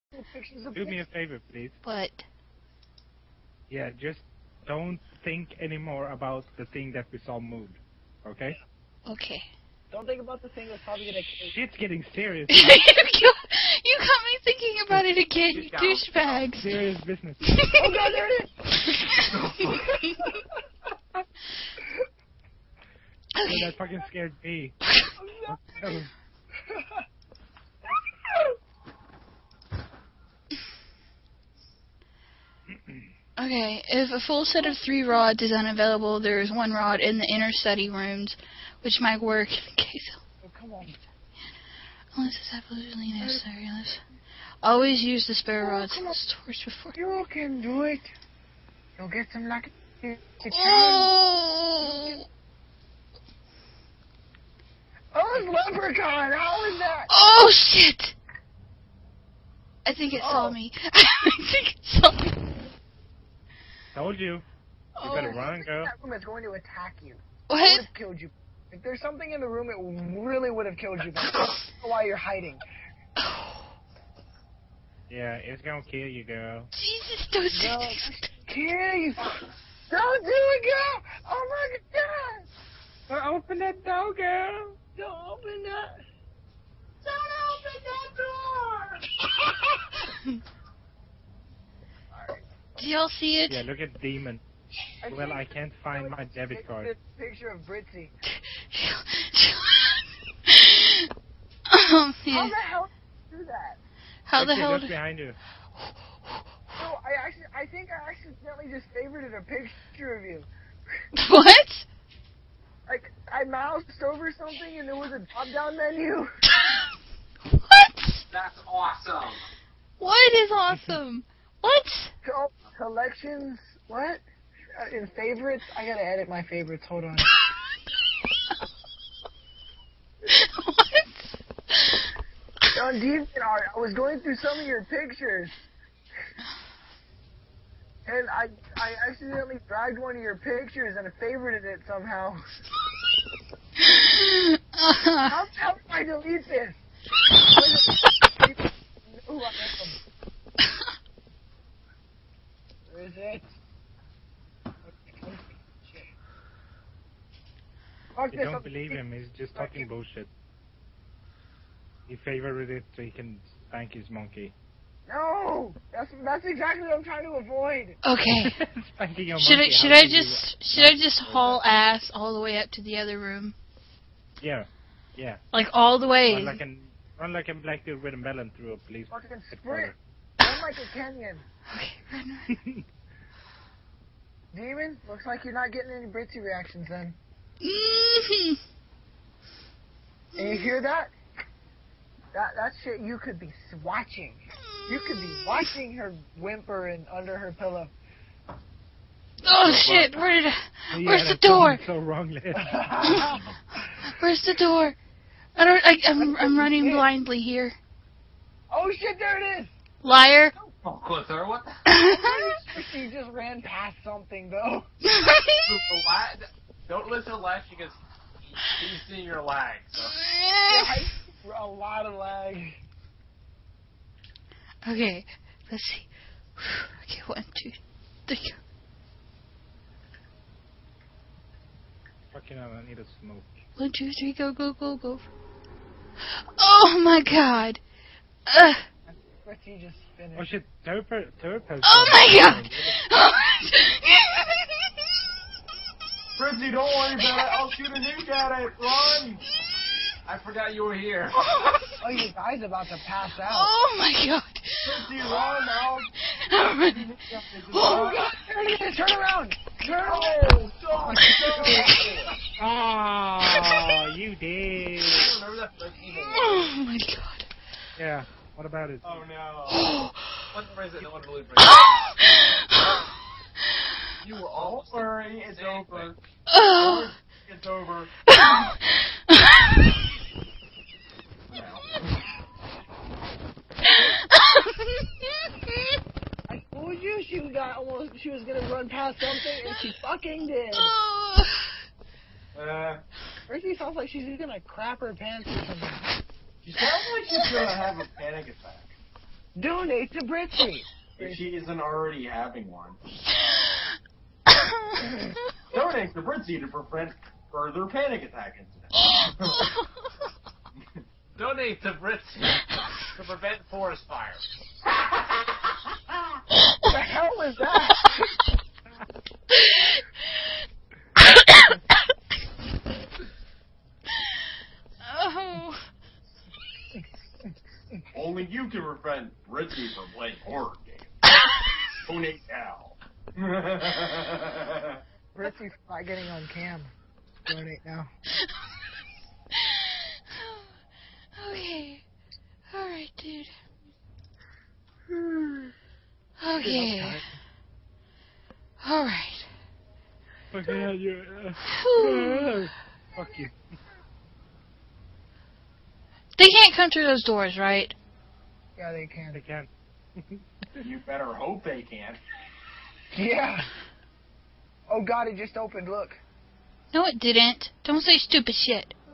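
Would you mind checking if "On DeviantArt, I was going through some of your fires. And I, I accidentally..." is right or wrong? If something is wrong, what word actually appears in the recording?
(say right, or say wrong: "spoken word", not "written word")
wrong: "pictures", not "fires".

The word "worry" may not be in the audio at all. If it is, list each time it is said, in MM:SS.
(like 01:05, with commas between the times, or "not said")
04:06, 04:34.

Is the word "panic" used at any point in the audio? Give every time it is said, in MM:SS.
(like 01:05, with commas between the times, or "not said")
04:58, 05:07.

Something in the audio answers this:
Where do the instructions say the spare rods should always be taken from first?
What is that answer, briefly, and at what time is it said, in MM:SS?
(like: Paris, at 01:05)
the stores, at 00:46.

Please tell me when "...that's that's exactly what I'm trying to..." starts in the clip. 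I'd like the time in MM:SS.
02:45.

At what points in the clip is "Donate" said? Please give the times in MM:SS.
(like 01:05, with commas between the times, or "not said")
04:59, 05:05, 05:11, 05:37.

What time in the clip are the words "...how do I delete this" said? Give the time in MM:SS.
02:25.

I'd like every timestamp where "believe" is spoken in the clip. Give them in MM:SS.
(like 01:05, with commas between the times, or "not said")
02:38, 04:31.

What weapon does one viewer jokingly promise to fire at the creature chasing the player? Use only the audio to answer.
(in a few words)
a nuke.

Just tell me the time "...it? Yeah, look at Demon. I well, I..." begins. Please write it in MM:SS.
01:33.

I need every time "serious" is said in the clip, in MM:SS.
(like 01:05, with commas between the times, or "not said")
00:12, 00:16.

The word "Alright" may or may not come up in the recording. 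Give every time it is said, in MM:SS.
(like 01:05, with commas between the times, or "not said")
05:42, 05:48.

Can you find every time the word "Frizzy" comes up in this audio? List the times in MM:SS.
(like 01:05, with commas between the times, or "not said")
04:06, 04:14.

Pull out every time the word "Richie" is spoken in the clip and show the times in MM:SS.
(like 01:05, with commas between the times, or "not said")
05:29, 05:35.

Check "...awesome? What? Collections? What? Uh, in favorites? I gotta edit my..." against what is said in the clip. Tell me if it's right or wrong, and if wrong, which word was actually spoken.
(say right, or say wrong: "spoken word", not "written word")
right.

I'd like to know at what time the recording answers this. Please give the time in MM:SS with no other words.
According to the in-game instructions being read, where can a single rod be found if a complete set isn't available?
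00:37.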